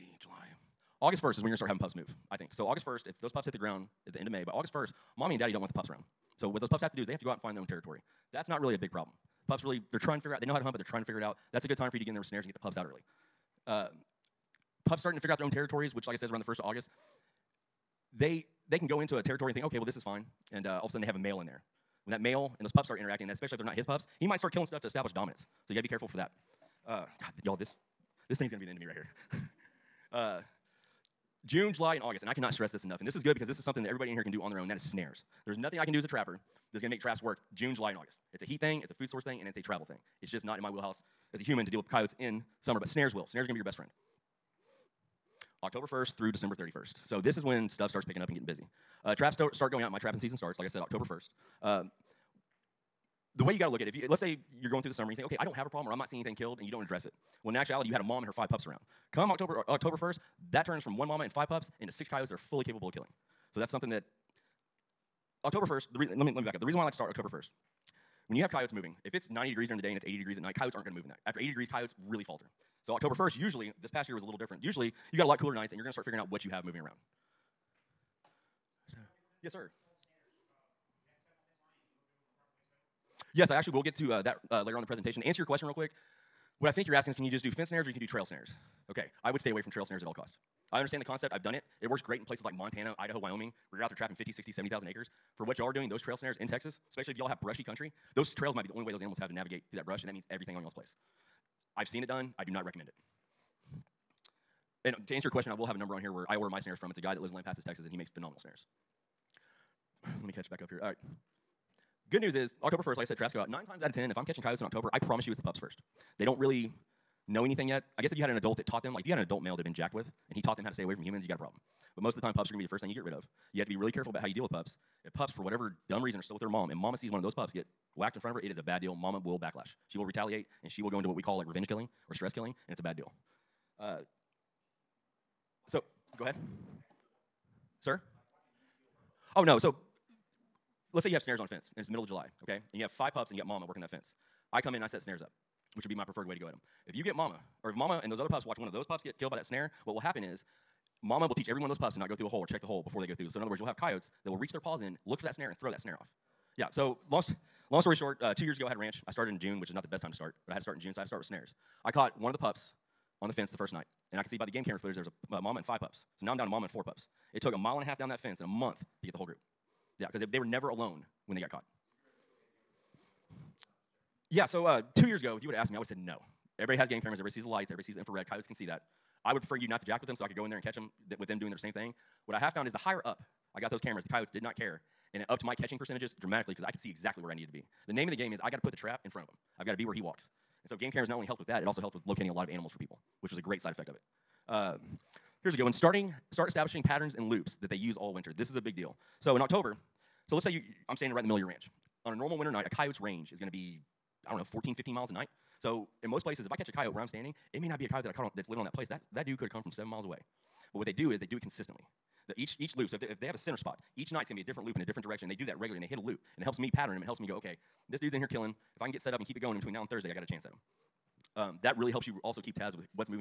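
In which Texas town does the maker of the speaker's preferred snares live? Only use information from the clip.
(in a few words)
Lampasas.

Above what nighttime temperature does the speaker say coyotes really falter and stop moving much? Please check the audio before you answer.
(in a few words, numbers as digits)
80 degrees.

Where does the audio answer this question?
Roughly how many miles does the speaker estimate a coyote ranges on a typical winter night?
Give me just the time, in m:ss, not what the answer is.
3:24.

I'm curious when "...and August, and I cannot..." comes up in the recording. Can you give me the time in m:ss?
0:31.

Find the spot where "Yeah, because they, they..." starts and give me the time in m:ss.
2:49.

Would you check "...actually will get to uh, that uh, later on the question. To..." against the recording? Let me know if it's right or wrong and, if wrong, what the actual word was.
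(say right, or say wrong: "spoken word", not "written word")
wrong: "presentation", not "question".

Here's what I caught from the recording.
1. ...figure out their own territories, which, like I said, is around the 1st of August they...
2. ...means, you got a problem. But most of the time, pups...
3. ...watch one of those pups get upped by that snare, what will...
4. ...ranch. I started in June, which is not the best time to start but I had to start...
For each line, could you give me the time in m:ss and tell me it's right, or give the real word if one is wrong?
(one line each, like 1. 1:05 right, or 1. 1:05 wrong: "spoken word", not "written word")
1. 0:15 right
2. 2:01 wrong: "humans", not "means"
3. 2:28 wrong: "killed", not "upped"
4. 2:38 right.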